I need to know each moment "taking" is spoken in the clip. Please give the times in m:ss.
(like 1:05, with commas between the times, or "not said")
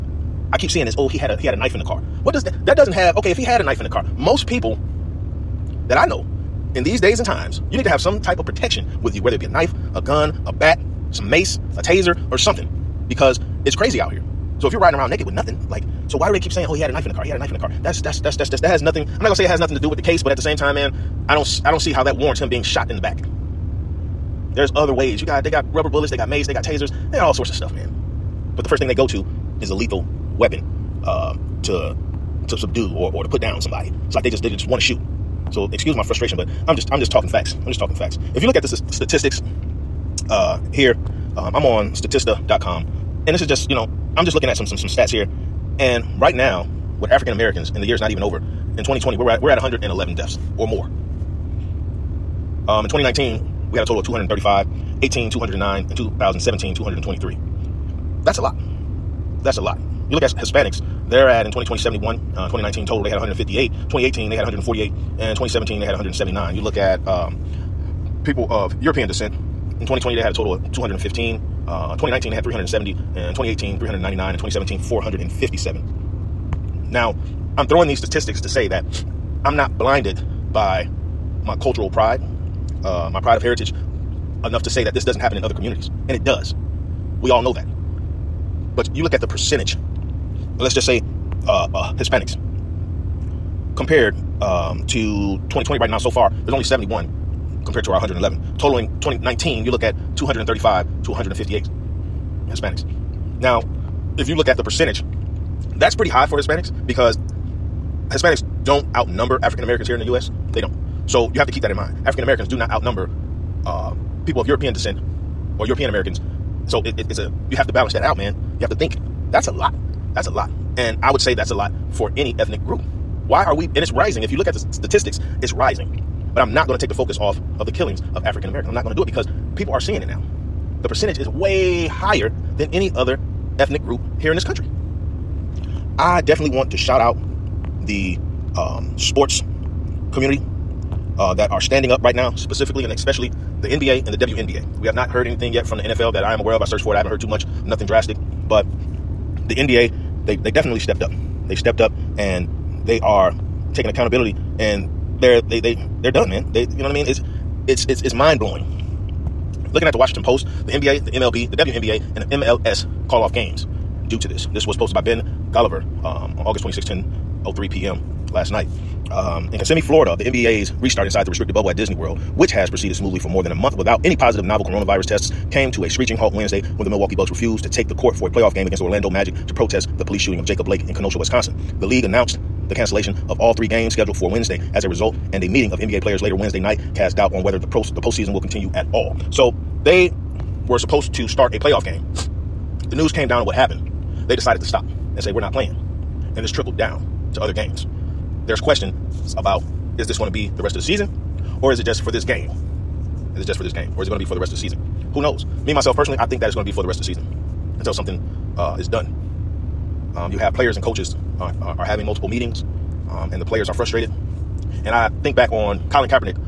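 2:33.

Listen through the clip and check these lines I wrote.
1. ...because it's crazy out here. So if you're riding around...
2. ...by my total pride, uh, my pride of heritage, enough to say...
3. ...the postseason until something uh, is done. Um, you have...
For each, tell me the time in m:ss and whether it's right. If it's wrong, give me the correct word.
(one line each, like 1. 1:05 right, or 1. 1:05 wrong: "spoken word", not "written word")
1. 0:13 right
2. 1:20 wrong: "cultural", not "total"
3. 3:27 wrong: "season", not "postseason".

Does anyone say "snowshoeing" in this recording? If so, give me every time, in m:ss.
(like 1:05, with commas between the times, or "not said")
not said.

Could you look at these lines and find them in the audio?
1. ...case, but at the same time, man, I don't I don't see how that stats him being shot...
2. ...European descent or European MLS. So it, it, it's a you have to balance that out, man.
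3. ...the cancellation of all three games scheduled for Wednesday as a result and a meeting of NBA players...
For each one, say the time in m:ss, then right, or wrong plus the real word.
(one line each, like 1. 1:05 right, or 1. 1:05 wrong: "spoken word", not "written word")
1. 0:20 wrong: "warrants", not "stats"
2. 1:54 wrong: "Americans", not "MLS"
3. 3:02 right.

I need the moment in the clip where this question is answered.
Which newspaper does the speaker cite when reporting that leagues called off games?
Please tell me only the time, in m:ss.
2:39.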